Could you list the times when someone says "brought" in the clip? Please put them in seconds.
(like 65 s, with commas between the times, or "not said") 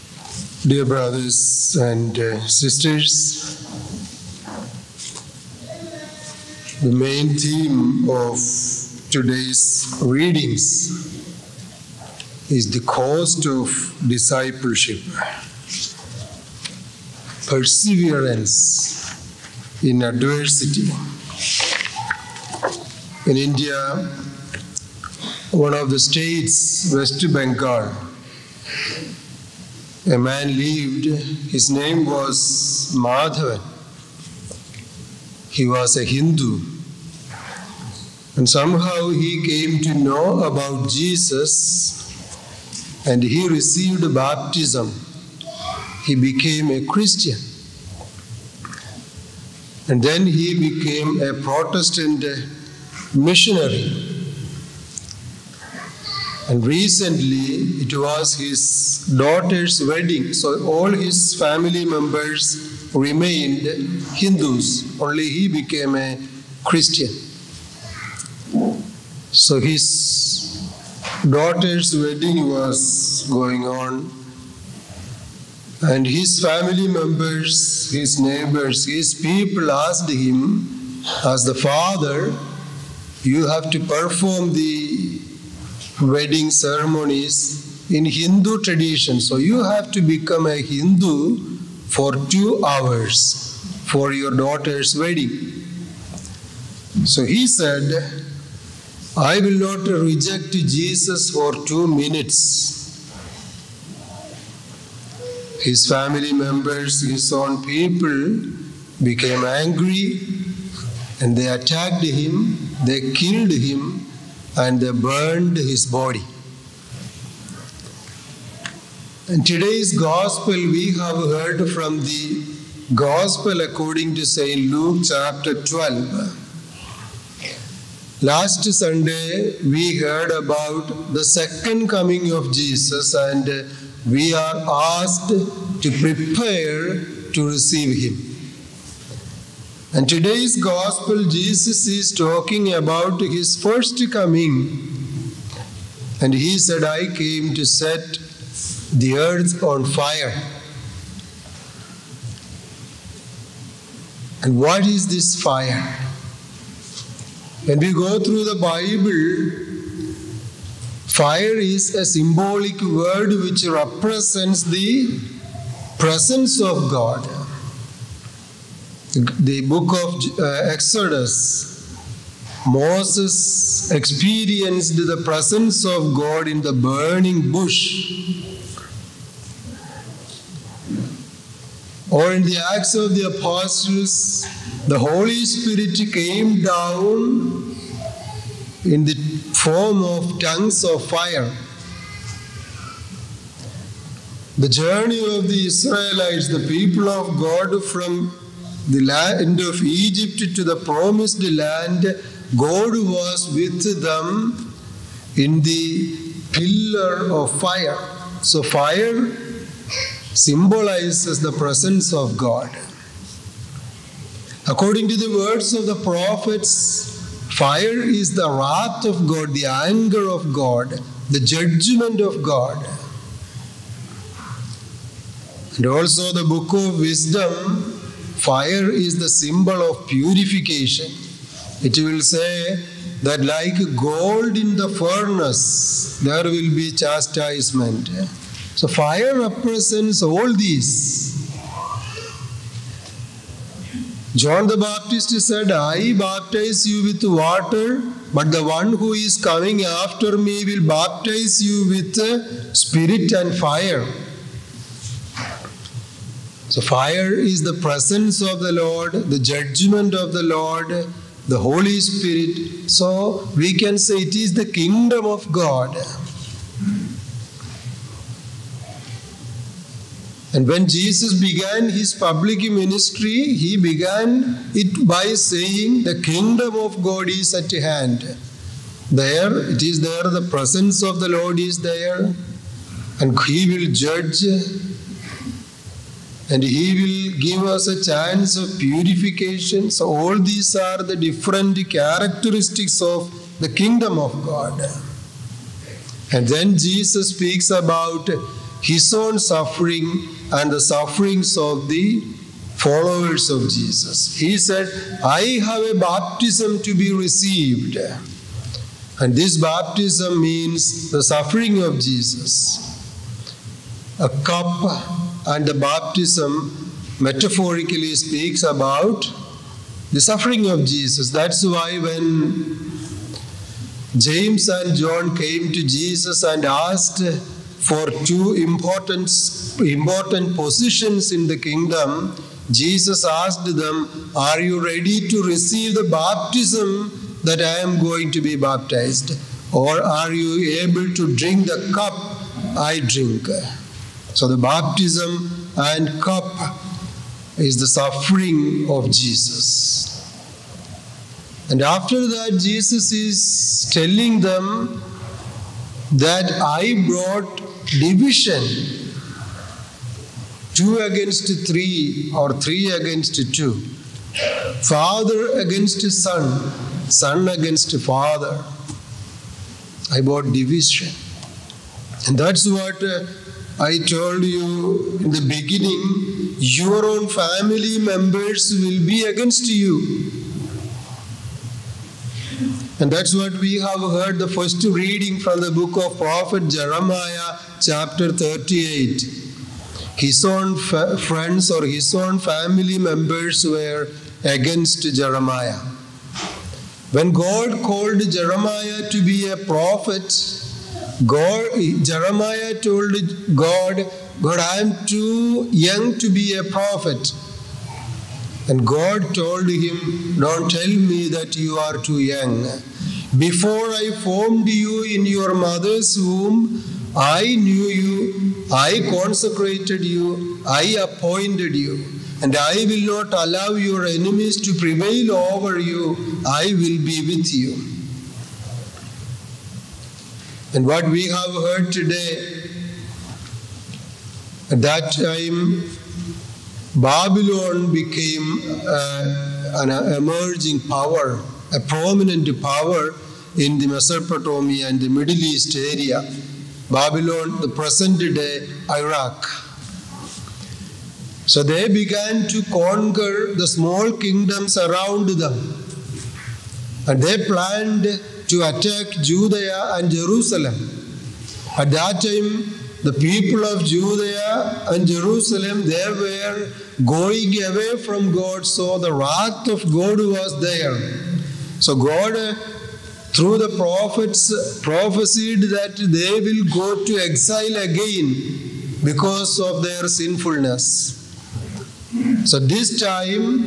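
357 s, 370 s.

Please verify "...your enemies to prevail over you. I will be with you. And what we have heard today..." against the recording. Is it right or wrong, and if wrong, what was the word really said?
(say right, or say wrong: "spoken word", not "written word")
right.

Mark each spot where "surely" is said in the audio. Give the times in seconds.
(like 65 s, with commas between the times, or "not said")
not said.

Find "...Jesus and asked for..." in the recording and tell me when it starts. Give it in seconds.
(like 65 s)
325 s.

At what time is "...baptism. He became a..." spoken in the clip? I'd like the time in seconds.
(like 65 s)
44 s.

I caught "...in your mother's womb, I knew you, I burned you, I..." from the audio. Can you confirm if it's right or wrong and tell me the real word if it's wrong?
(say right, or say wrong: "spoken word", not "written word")
wrong: "consecrated", not "burned".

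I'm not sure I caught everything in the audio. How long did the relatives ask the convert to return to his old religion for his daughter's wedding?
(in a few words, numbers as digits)
2 hours.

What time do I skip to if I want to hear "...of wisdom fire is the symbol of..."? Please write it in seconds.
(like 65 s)
226 s.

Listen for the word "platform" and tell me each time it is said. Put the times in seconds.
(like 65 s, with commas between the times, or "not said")
not said.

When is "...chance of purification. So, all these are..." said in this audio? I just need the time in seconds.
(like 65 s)
288 s.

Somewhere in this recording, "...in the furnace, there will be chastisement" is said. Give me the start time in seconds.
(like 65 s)
234 s.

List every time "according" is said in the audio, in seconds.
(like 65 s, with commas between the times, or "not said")
123 s, 214 s.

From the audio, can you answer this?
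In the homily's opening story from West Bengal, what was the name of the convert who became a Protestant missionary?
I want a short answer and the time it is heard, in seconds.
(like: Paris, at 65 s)
Madhavan, at 32 s.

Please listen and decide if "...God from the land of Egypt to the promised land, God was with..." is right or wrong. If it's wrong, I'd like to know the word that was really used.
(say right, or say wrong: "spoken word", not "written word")
right.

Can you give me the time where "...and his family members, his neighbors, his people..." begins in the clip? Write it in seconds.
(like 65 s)
75 s.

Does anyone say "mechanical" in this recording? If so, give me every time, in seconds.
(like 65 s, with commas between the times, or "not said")
not said.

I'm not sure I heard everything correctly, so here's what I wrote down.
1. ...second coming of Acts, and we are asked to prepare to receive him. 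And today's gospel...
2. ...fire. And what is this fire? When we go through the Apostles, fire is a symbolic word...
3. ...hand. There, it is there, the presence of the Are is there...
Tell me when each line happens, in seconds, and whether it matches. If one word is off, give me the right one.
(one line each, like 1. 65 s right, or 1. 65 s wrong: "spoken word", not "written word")
1. 131 s wrong: "Jesus", not "Acts"
2. 149 s wrong: "Bible", not "Apostles"
3. 277 s wrong: "Lord", not "Are".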